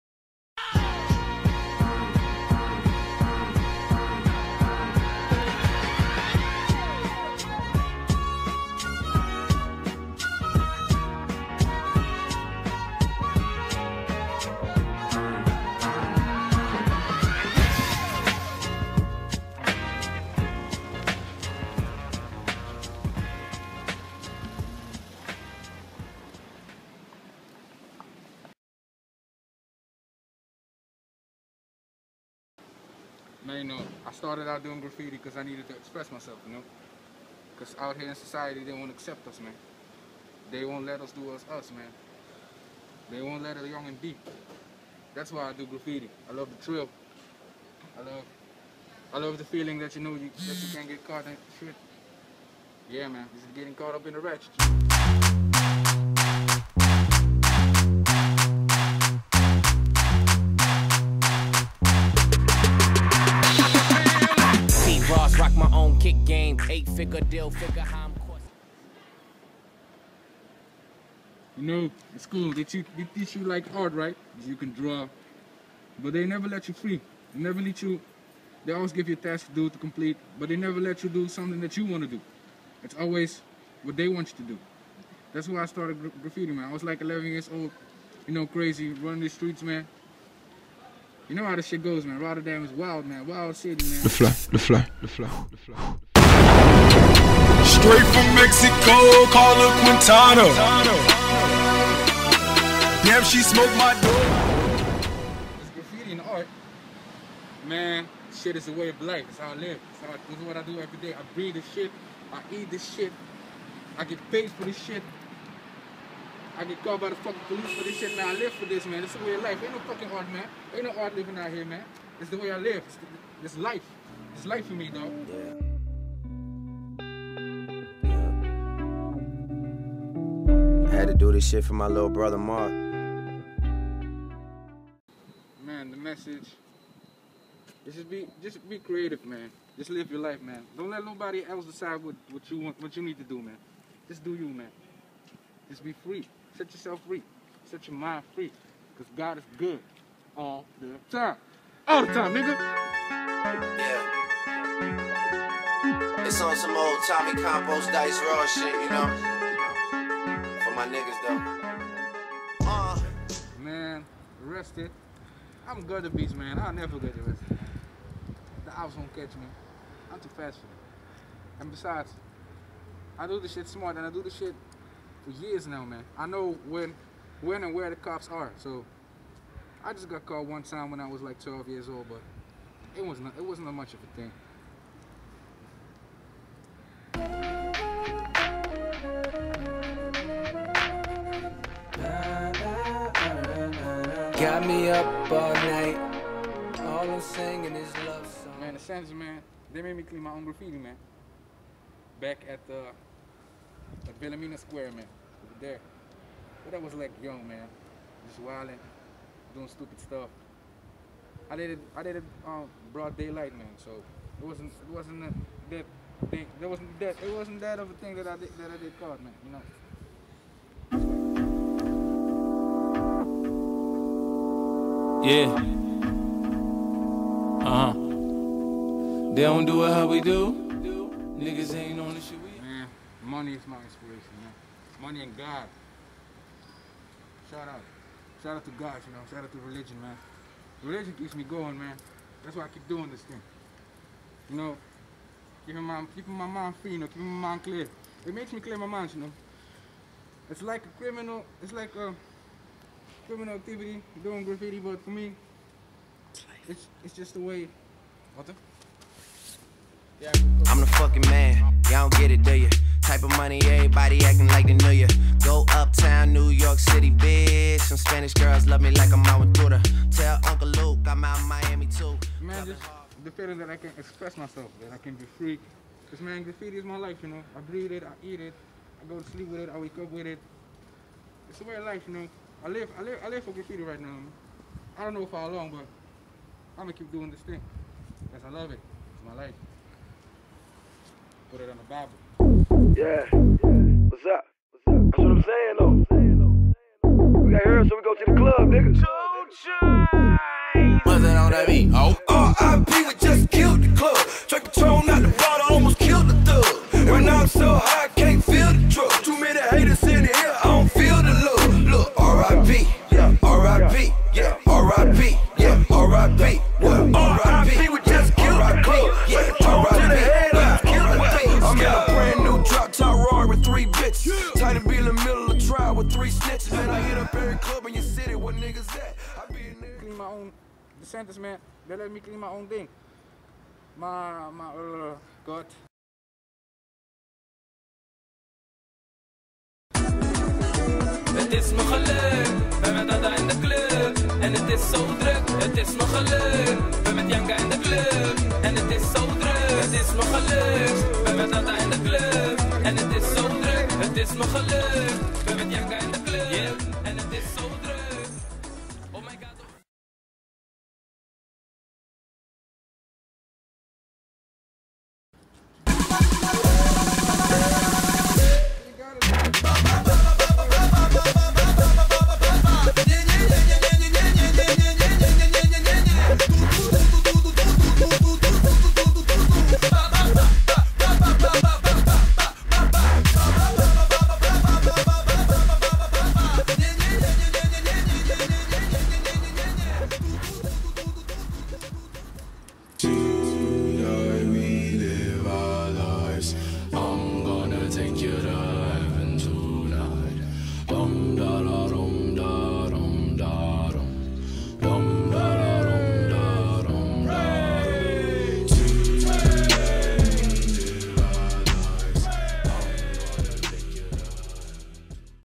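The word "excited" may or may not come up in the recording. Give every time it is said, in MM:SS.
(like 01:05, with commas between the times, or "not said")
not said.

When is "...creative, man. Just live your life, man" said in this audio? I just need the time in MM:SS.
02:18.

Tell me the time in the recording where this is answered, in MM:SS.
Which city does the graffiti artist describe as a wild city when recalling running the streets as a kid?
01:32.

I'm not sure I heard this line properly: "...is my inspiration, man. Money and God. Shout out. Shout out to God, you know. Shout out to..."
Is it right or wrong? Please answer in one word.
right.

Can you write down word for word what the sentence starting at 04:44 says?
I don't know for how long, but I'm gonna keep doing this thing.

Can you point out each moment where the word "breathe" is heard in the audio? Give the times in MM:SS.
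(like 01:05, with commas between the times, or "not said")
01:51, 04:37.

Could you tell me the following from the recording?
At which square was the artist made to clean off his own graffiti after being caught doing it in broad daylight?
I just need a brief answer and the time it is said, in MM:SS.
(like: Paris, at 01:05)
Bellamina Square, at 03:24.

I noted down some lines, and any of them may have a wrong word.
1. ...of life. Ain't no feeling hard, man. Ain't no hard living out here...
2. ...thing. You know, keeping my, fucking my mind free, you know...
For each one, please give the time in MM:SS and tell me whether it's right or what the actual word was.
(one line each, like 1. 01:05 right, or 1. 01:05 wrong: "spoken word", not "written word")
1. 01:59 wrong: "fucking", not "feeling"
2. 04:03 wrong: "keeping", not "fucking".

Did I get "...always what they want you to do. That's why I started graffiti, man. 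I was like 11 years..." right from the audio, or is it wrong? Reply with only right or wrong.
right.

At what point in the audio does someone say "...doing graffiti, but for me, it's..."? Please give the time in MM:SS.
04:14.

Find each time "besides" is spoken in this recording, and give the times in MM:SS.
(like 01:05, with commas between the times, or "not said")
02:51.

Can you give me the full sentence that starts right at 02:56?
I know when, when and where the cops are.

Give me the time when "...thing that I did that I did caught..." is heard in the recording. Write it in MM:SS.
03:37.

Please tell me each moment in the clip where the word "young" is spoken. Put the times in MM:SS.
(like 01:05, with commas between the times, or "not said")
00:43, 03:27.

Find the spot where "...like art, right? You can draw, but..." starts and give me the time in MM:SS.
01:13.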